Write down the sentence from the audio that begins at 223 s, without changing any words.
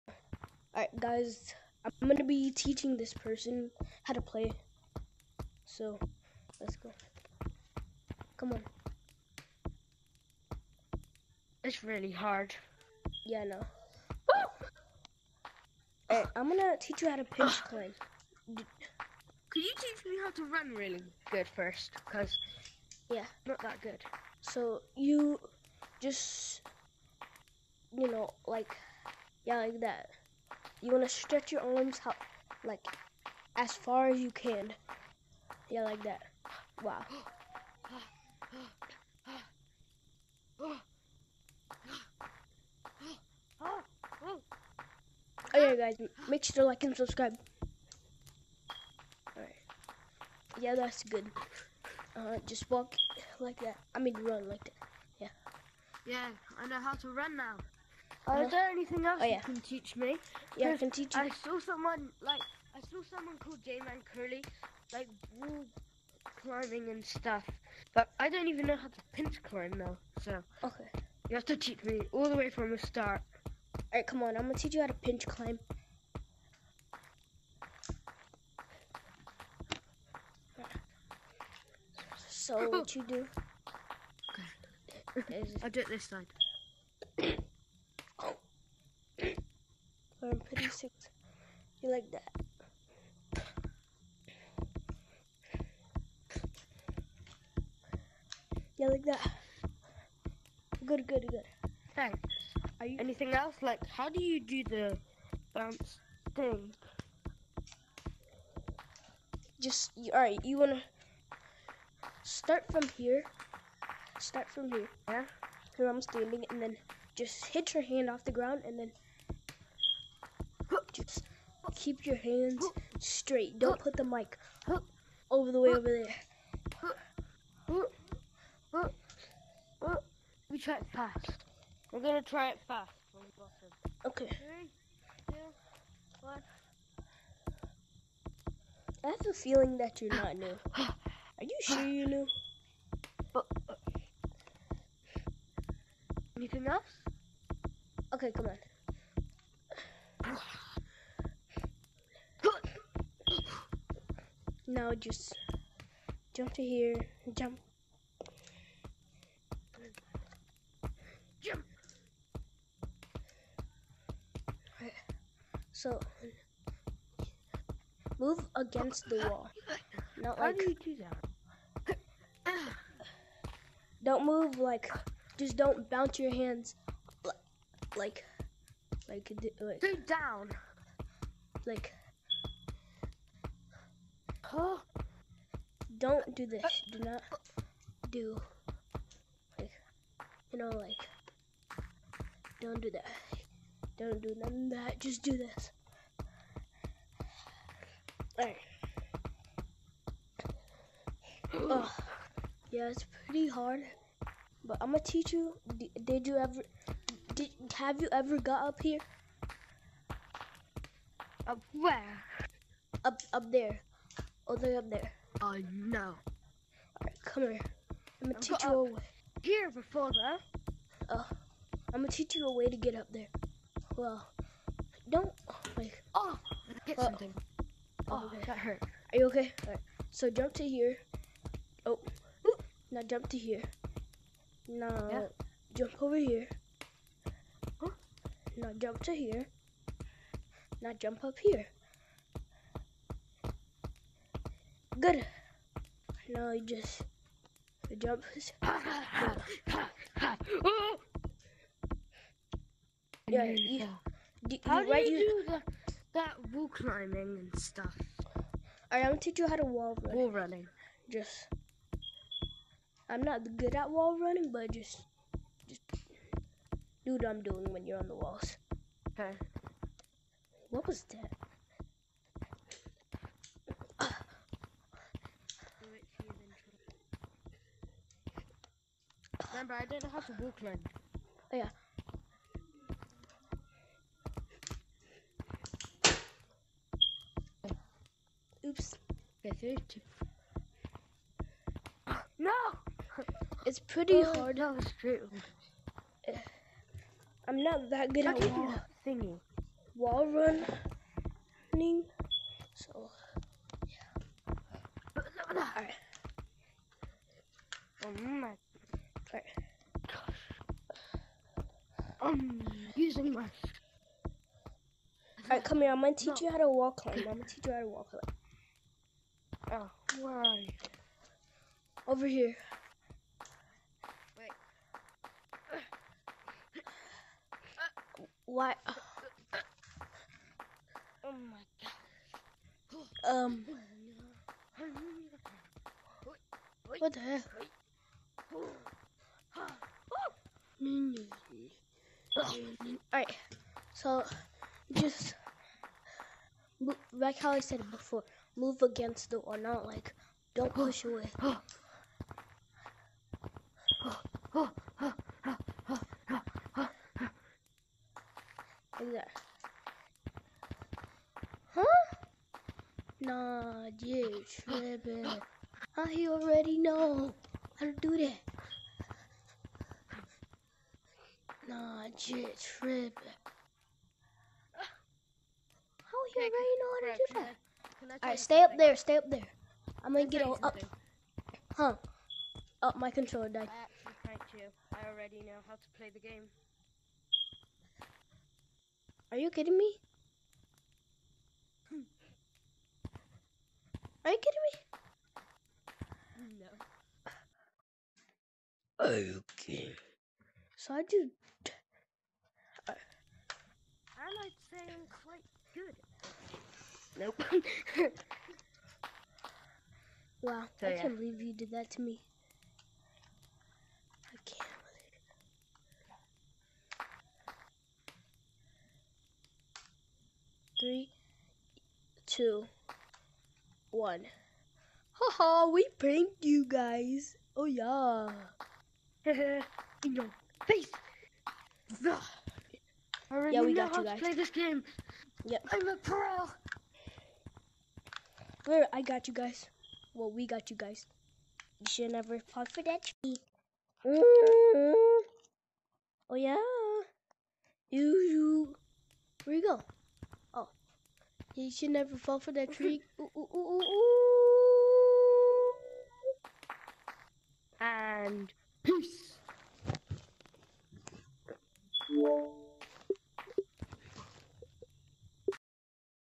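Well, don't, like, oh, hit uh, something.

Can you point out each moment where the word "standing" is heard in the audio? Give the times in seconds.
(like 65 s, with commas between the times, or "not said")
116 s.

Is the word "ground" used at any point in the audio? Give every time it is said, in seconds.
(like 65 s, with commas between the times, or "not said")
118 s.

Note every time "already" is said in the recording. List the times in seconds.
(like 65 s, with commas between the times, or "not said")
366 s, 376 s, 385 s, 433 s.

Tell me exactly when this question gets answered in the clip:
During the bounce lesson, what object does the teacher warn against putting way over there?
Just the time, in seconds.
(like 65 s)
123 s.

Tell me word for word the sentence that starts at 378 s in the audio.
Alright, stay up there, stay up there.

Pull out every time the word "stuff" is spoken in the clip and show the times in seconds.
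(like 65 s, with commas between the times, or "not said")
67 s, 257 s.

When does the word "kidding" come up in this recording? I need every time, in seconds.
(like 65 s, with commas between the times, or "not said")
389 s, 394 s.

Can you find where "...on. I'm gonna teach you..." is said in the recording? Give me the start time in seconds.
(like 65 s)
74 s.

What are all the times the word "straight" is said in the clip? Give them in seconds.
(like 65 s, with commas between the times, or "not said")
122 s.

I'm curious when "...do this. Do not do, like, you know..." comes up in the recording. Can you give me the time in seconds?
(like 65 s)
186 s.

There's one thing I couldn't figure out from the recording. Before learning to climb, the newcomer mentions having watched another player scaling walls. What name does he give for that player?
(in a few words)
J-Man Curly.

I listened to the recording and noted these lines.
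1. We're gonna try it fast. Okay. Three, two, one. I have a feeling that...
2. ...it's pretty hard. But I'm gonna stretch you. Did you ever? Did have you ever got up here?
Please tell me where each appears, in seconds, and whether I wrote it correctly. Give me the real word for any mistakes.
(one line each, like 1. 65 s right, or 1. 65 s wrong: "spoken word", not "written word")
1. 131 s right
2. 202 s wrong: "teach", not "stretch".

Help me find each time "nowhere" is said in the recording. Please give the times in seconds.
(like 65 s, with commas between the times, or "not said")
not said.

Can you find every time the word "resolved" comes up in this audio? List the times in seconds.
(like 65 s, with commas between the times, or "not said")
not said.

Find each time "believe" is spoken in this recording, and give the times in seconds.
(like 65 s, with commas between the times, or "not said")
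411 s, 420 s.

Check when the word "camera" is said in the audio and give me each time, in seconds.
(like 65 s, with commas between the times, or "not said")
not said.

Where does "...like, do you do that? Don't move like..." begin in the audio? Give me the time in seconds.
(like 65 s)
170 s.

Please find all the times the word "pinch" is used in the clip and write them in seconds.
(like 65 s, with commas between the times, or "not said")
17 s, 69 s, 74 s.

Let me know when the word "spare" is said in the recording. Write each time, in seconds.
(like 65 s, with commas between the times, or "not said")
not said.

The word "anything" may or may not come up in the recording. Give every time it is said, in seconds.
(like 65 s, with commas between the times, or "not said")
58 s, 102 s, 146 s.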